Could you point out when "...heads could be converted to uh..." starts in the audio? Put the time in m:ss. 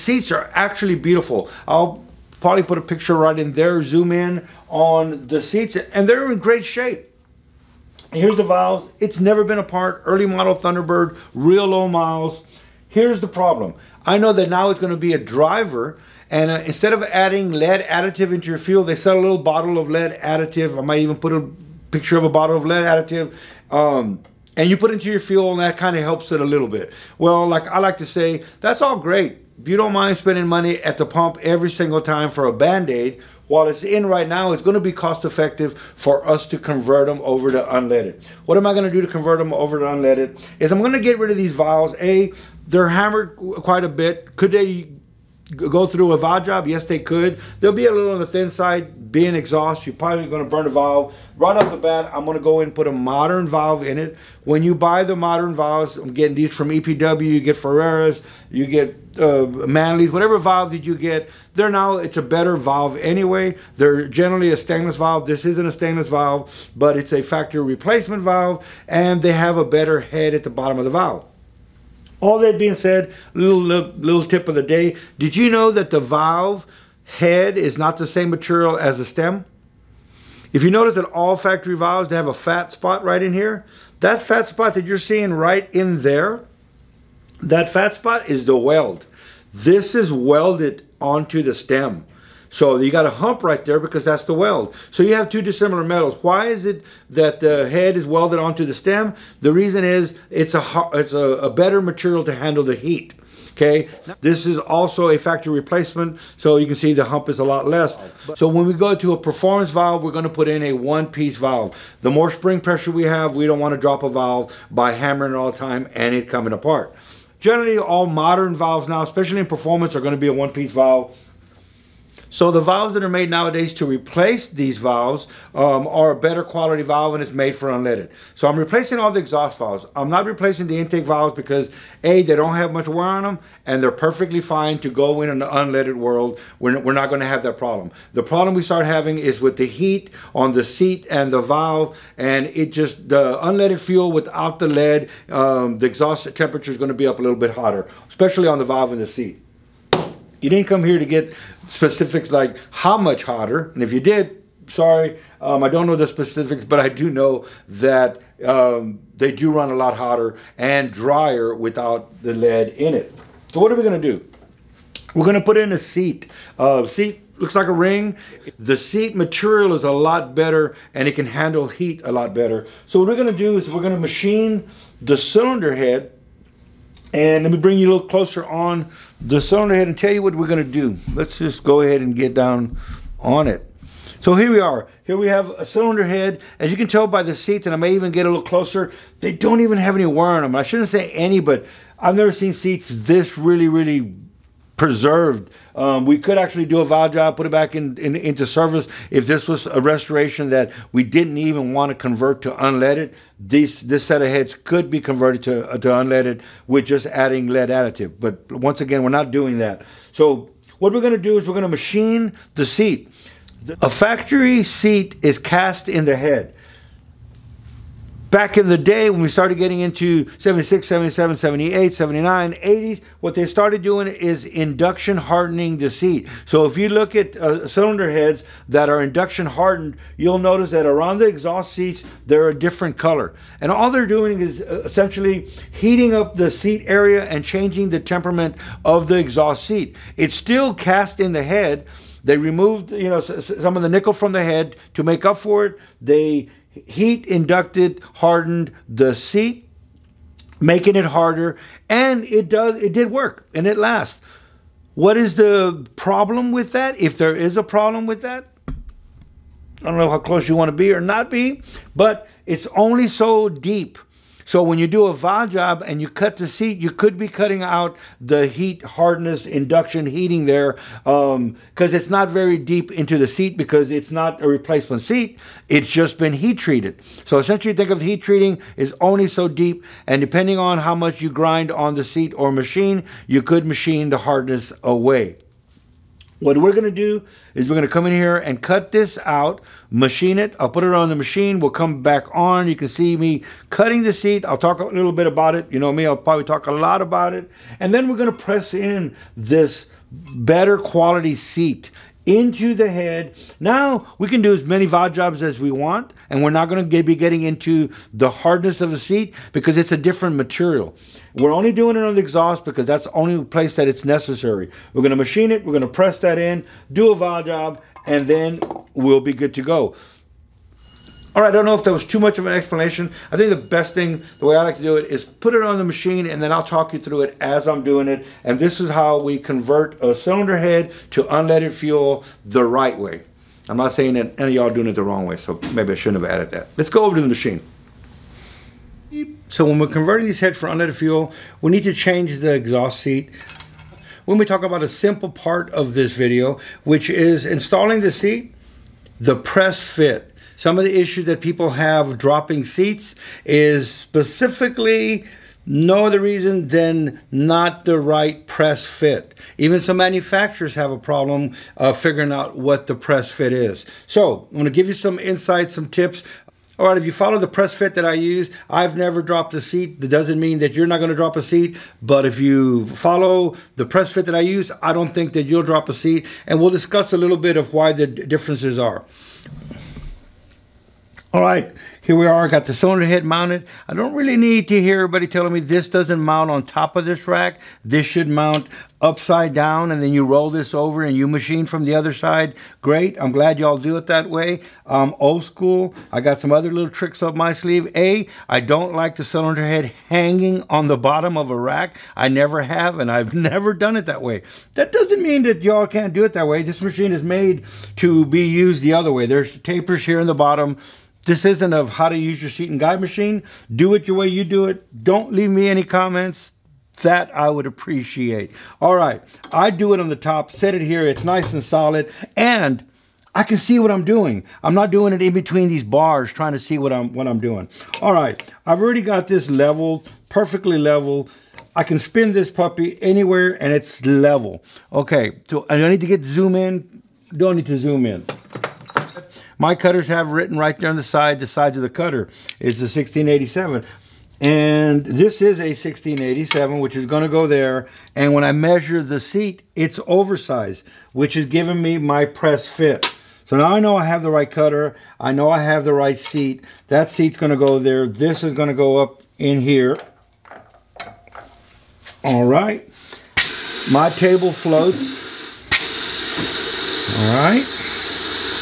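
3:24.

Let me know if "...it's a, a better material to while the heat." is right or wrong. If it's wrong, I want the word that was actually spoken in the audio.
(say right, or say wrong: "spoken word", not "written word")
wrong: "handle", not "while".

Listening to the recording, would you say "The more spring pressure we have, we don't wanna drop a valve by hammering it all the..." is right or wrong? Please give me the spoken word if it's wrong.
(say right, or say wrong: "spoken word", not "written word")
right.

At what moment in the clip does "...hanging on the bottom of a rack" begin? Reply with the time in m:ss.
6:40.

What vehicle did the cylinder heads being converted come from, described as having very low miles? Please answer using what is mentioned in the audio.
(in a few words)
Early model Thunderbird.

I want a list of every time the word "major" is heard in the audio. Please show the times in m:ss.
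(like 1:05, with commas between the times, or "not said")
not said.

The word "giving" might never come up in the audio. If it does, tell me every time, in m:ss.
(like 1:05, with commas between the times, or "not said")
7:31.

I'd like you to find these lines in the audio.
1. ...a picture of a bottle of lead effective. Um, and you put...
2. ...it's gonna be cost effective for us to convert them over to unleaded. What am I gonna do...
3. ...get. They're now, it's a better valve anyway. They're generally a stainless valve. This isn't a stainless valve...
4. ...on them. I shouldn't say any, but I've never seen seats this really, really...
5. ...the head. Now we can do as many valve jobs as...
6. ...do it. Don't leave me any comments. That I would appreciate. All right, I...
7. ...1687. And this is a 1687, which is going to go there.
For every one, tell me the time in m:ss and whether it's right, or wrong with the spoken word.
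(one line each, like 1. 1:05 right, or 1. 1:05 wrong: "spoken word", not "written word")
1. 0:21 wrong: "additive", not "effective"
2. 0:34 right
3. 1:00 right
4. 3:10 right
5. 5:02 right
6. 6:54 right
7. 7:22 right.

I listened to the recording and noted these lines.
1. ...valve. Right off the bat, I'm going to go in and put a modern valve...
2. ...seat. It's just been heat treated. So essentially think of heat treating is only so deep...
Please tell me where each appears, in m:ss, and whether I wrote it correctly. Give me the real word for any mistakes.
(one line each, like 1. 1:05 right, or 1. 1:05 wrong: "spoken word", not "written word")
1. 0:50 right
2. 4:35 right.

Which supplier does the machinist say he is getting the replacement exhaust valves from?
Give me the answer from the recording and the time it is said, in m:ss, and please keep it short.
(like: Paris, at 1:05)
EPW, at 0:56.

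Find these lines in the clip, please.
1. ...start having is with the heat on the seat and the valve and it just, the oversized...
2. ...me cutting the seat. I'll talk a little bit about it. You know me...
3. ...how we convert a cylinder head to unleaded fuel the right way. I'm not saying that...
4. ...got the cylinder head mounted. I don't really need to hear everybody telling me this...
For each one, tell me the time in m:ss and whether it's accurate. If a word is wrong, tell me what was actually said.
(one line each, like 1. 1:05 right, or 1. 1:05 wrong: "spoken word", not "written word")
1. 2:18 wrong: "unleaded", not "oversized"
2. 4:53 right
3. 5:28 right
4. 6:22 right.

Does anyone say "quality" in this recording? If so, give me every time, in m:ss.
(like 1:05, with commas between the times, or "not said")
2:06, 5:00.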